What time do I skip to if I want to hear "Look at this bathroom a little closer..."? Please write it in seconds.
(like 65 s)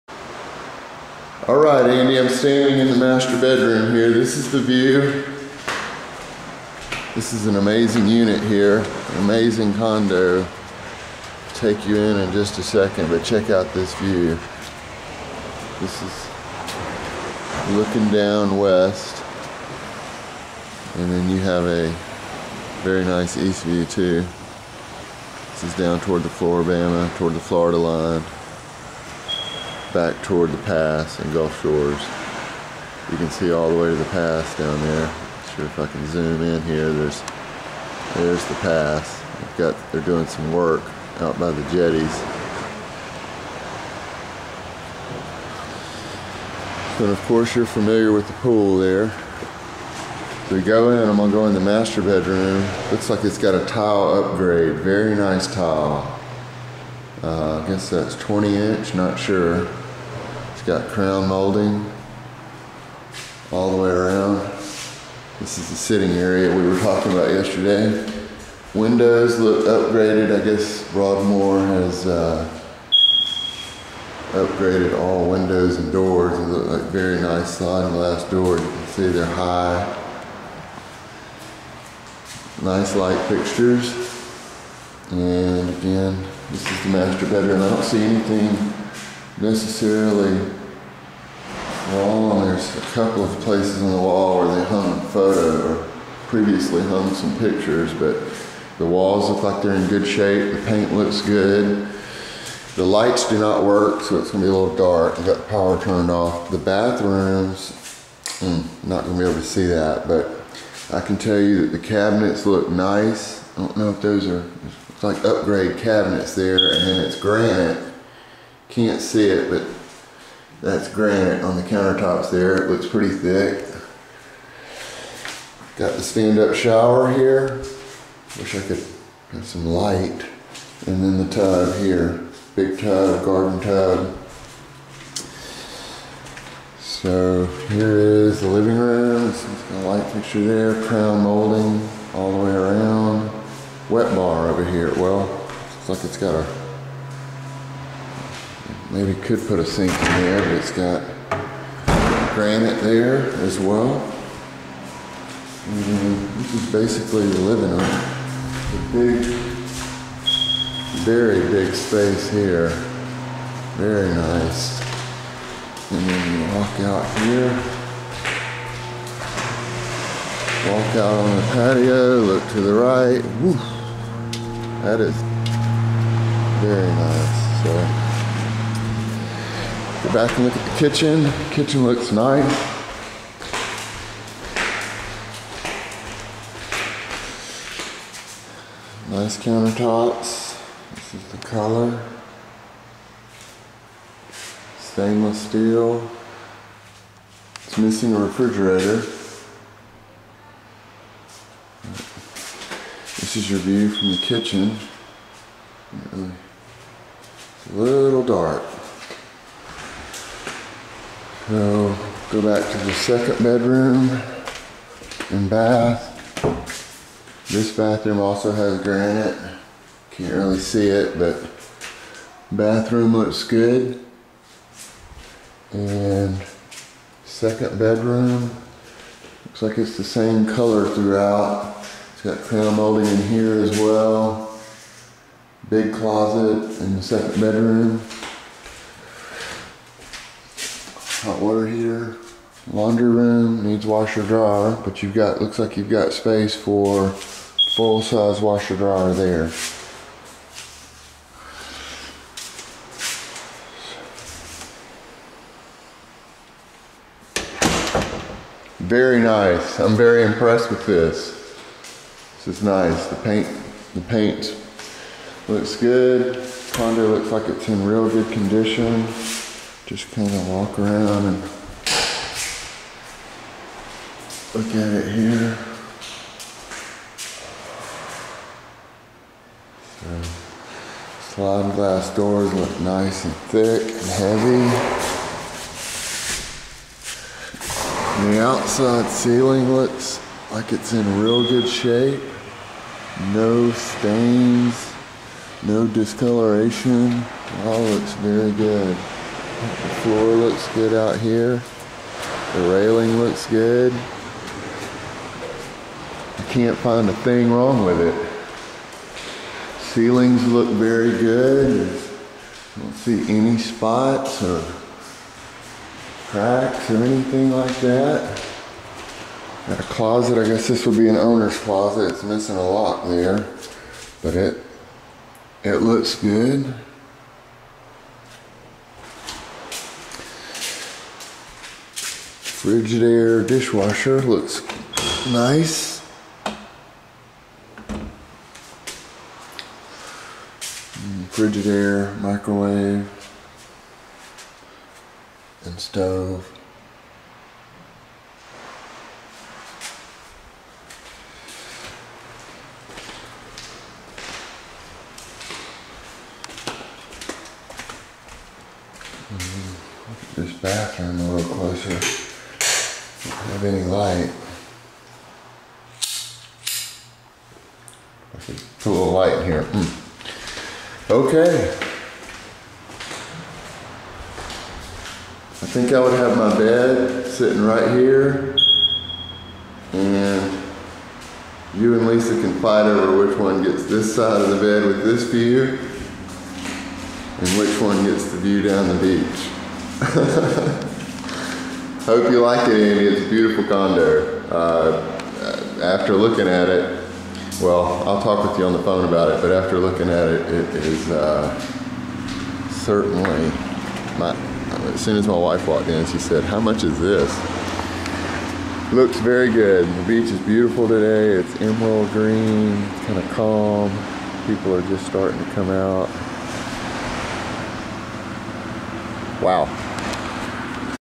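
360 s.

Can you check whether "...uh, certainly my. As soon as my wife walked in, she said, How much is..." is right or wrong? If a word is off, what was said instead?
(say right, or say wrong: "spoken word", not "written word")
right.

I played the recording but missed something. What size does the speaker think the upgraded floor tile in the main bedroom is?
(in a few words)
20 inch.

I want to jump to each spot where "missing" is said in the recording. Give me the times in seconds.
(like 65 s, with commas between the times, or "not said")
197 s, 322 s.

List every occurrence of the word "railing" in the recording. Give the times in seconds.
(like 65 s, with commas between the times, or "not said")
302 s.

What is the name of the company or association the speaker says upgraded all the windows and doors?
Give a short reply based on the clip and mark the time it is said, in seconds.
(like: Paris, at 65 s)
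Broadmoor, at 70 s.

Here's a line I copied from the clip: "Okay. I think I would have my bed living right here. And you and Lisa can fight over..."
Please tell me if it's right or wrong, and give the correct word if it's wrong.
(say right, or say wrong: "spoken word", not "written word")
wrong: "sitting", not "living".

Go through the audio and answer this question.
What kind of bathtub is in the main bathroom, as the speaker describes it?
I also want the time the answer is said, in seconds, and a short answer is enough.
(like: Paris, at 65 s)
Garden tub, at 133 s.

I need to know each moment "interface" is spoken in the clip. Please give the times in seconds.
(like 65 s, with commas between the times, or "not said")
not said.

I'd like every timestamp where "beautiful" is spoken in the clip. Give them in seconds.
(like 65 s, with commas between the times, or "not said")
393 s, 410 s.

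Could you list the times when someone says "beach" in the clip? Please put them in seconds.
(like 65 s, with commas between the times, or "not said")
389 s, 410 s.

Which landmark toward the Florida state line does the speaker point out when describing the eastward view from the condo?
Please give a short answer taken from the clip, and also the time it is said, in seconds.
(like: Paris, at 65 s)
Floribama, at 26 s.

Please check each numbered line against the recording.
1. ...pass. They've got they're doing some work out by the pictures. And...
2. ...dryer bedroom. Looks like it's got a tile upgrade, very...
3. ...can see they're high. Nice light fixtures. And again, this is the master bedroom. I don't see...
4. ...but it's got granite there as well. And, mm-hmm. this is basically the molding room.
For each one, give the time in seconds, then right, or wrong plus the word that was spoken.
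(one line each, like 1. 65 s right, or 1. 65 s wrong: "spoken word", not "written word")
1. 38 s wrong: "jetties", not "pictures"
2. 51 s wrong: "master", not "dryer"
3. 78 s right
4. 150 s wrong: "living", not "molding".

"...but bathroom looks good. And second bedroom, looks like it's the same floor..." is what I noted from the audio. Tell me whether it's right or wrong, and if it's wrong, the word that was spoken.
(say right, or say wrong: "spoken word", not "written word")
wrong: "color", not "floor".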